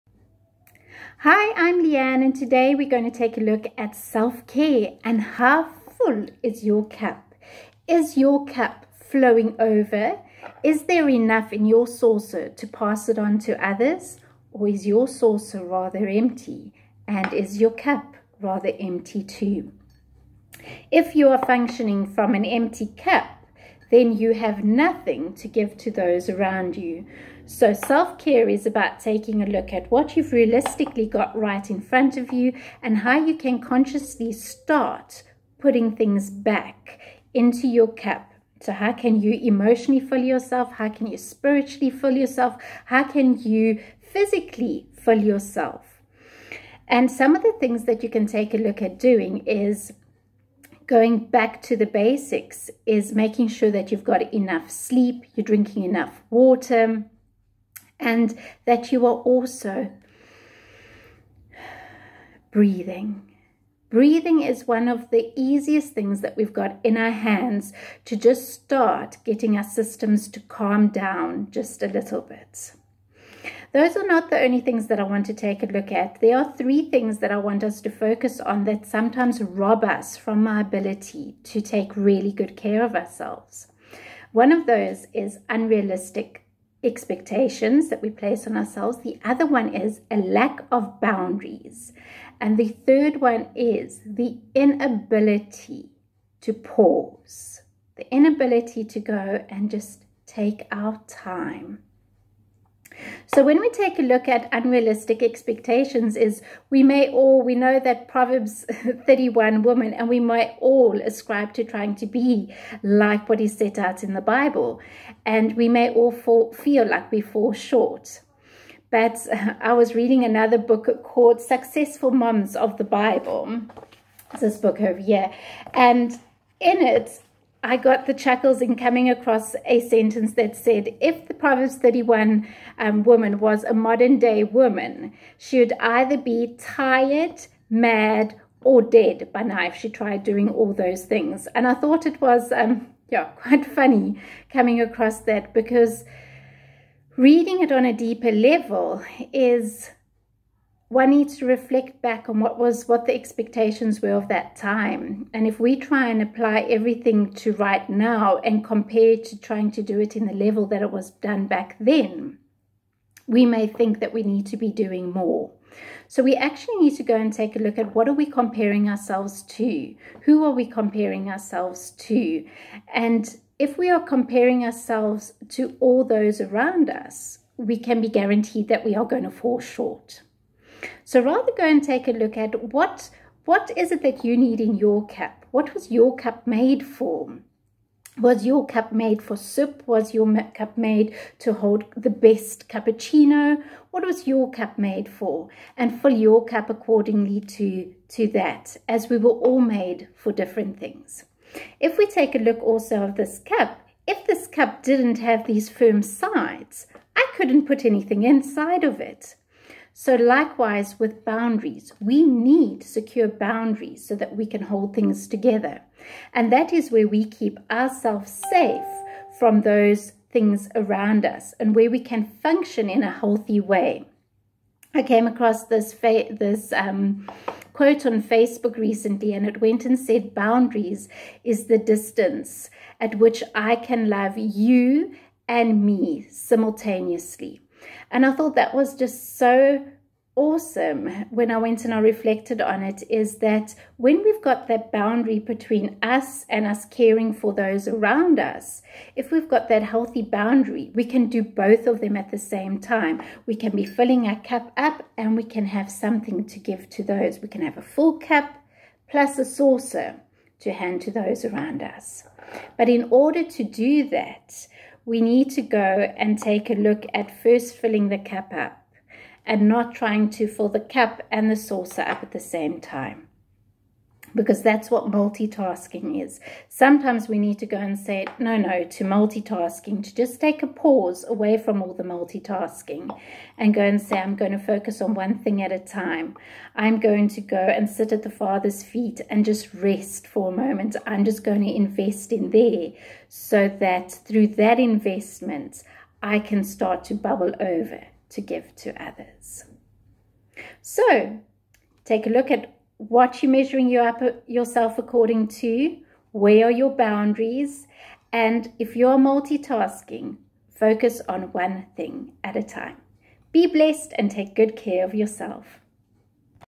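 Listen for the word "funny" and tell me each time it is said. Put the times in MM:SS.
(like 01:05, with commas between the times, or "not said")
02:23.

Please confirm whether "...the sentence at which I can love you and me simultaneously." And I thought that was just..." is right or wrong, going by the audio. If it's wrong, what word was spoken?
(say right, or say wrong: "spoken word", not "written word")
wrong: "distance", not "sentence".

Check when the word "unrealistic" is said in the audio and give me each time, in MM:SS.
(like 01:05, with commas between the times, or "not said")
01:25, 01:44.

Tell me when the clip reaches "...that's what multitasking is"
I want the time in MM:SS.
04:34.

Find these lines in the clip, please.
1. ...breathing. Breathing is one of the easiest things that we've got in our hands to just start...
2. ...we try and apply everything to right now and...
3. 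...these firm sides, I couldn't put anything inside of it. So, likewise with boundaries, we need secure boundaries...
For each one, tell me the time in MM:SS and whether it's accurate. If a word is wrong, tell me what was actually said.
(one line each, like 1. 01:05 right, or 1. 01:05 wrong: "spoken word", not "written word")
1. 01:02 right
2. 02:35 right
3. 03:25 right.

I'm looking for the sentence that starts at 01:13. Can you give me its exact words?
Those are not the only things that I want to take a look at.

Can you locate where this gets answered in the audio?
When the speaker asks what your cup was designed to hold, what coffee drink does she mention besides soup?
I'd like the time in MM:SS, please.
03:12.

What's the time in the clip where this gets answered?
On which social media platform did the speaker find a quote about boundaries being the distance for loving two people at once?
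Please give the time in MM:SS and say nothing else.
03:48.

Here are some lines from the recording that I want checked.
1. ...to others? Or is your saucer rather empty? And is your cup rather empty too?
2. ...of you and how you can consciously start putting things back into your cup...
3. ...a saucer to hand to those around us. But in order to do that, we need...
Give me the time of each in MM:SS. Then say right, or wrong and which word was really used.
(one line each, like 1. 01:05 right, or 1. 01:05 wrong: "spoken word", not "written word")
1. 00:13 right
2. 00:32 right
3. 04:19 right.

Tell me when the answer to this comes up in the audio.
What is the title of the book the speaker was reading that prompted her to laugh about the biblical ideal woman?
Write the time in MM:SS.
02:01.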